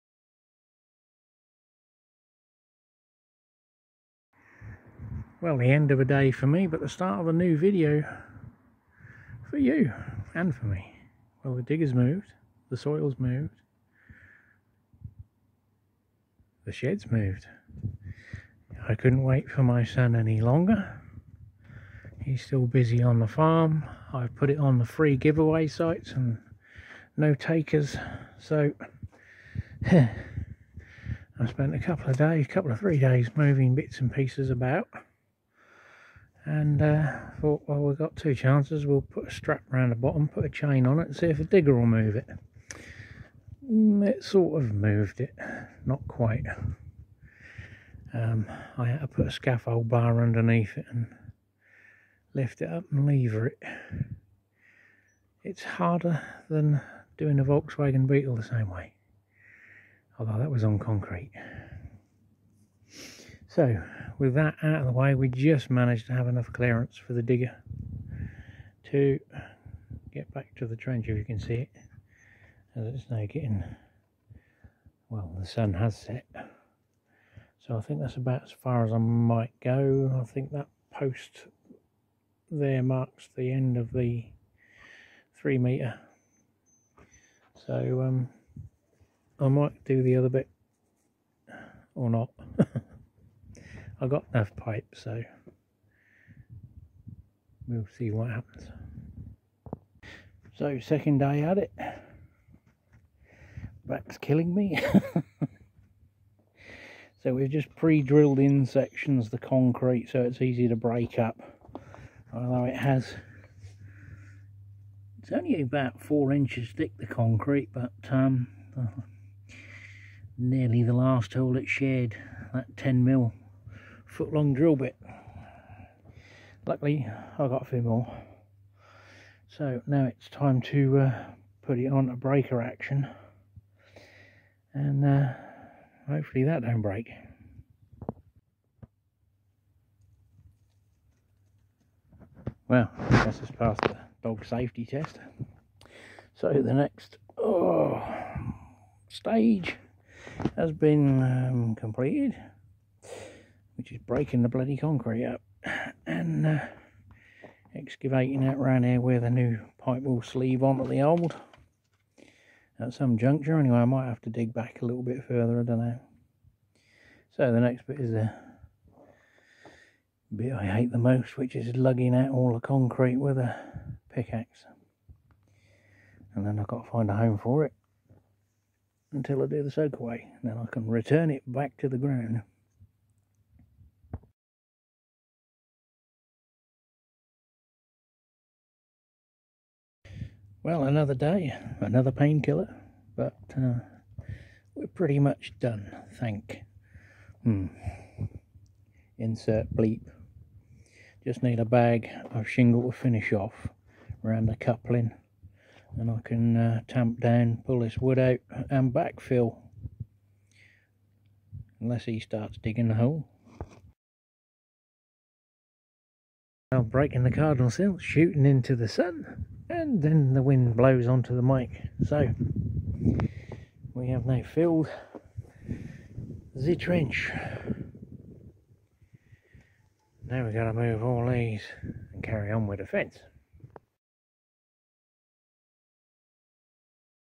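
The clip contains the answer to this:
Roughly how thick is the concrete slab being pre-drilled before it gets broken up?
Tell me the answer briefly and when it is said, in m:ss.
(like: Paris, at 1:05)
4 inches, at 1:56.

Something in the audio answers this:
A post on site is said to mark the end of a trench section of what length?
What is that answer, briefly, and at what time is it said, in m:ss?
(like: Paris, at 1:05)
3 metres, at 1:25.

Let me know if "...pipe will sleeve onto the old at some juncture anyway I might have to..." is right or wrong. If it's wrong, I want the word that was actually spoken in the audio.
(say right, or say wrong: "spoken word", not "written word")
right.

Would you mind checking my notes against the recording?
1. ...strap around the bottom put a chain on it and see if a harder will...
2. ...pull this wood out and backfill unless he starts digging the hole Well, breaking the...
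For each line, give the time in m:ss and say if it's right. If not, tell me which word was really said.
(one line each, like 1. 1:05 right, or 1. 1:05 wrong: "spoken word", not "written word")
1. 0:39 wrong: "digger", not "harder"
2. 3:27 right.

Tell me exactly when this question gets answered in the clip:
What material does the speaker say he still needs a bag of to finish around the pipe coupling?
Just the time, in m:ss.
3:22.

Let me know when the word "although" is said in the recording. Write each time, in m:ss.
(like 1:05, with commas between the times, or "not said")
1:00, 1:52.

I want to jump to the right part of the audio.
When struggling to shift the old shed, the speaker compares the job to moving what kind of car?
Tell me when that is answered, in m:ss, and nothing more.
0:57.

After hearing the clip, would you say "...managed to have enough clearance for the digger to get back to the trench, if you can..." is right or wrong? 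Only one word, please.
right.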